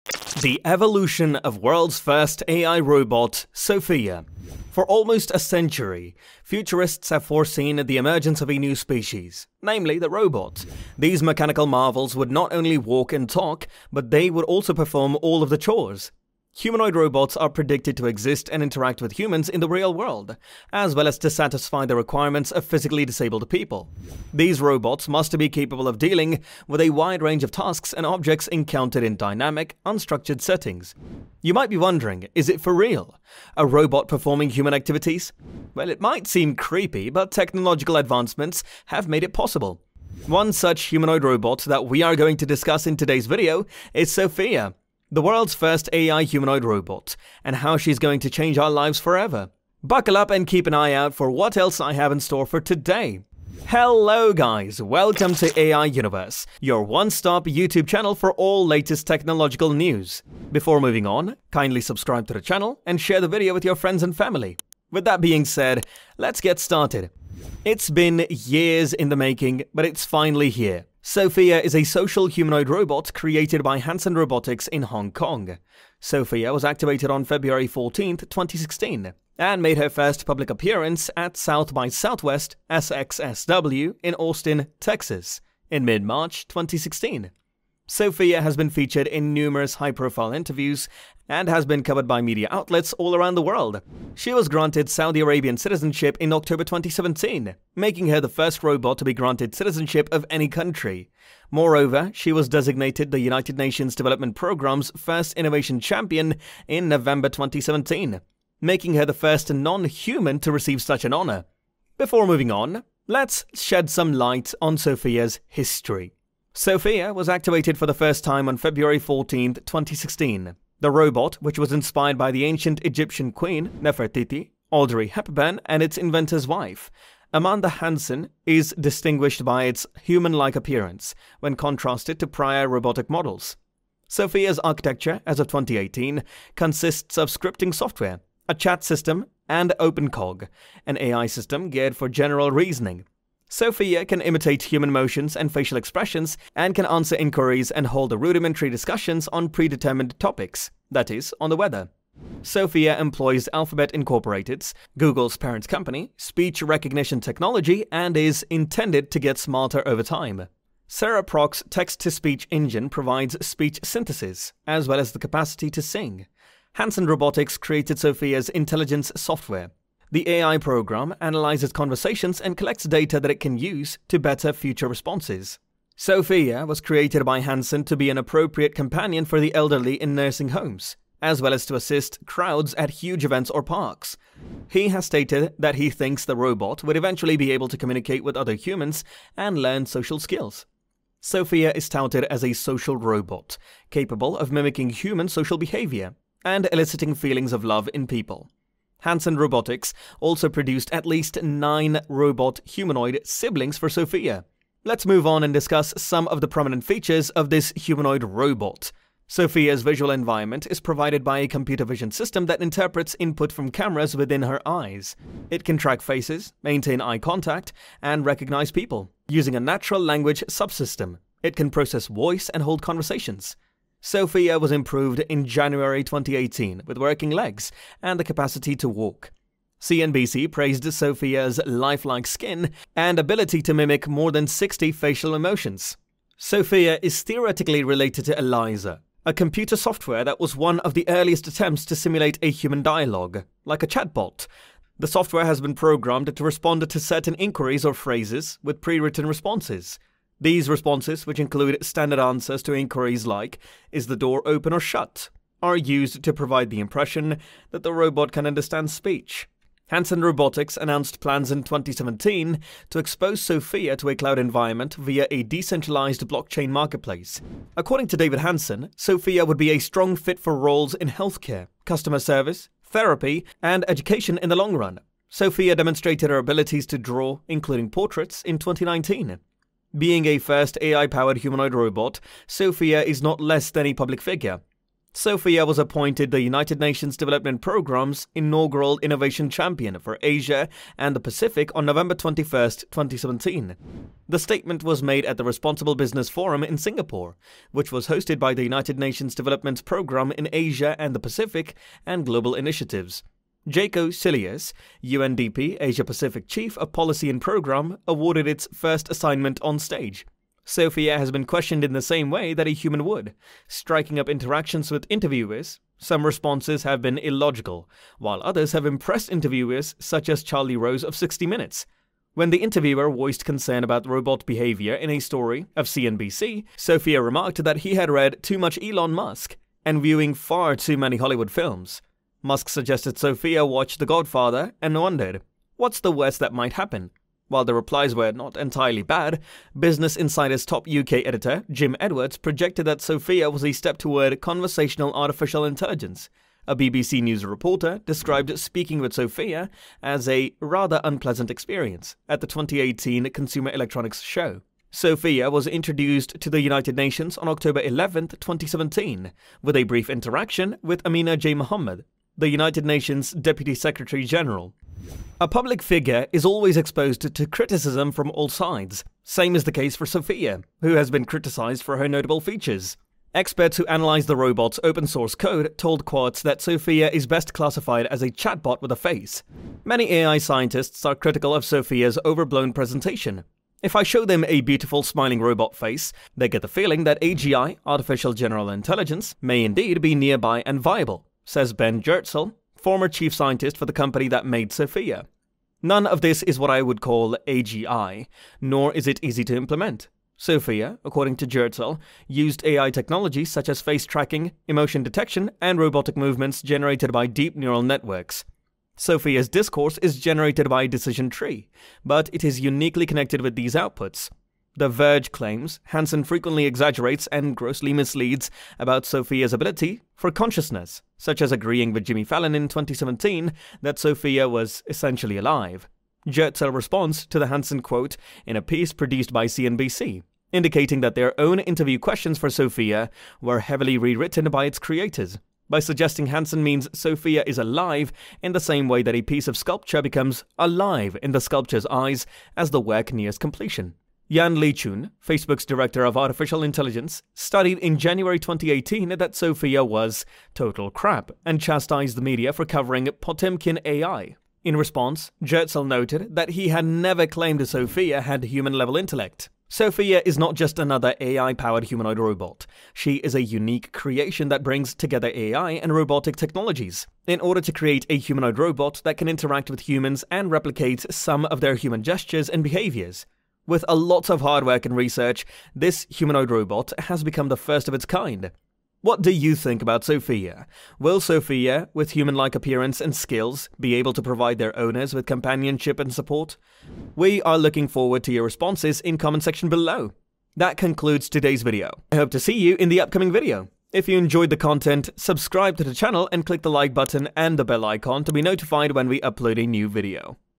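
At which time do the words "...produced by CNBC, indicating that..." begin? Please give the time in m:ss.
7:08.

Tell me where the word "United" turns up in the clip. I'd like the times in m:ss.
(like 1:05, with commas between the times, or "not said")
1:43, 4:46, 4:58, 5:56, 6:02.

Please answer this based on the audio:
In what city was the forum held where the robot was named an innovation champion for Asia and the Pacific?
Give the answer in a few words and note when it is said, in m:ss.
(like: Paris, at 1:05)
Singapore, at 4:56.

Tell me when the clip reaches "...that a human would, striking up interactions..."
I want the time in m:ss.
5:12.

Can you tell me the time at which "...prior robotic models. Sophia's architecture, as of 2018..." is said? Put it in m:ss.
2:12.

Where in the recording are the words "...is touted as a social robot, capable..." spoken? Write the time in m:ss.
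3:11.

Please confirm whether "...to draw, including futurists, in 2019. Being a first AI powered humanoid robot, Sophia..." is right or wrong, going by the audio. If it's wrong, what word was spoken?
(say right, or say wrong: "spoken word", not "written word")
wrong: "portraits", not "futurists".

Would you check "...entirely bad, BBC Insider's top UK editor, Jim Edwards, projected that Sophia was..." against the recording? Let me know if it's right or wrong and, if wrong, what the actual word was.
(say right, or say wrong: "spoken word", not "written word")
wrong: "Business", not "BBC".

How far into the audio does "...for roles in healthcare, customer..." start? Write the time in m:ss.
4:30.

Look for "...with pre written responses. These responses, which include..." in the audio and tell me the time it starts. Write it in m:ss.
4:08.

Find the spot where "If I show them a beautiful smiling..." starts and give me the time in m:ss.
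6:23.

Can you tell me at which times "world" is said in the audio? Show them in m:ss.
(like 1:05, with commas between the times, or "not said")
0:01, 0:19, 0:45, 1:33.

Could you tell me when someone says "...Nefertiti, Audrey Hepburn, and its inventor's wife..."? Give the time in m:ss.
2:03.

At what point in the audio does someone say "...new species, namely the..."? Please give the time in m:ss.
0:08.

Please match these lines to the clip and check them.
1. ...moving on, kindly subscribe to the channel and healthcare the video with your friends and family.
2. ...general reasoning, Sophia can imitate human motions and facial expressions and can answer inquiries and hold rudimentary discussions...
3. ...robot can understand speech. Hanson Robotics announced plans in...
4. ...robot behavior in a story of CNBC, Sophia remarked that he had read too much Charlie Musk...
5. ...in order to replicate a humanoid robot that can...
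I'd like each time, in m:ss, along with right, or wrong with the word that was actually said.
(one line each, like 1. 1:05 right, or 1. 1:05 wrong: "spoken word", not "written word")
1. 1:00 wrong: "share", not "healthcare"
2. 2:22 right
3. 4:17 right
4. 5:24 wrong: "Elon", not "Charlie"
5. 7:47 wrong: "create", not "replicate".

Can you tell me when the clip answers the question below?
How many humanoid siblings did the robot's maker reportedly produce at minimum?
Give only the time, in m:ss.
3:21.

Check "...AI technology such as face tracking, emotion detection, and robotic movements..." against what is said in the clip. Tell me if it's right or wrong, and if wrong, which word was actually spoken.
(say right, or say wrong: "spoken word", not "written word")
right.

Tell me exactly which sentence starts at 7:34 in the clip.
In response, Goertzel noted that he had never claimed Sophia had human level intellect.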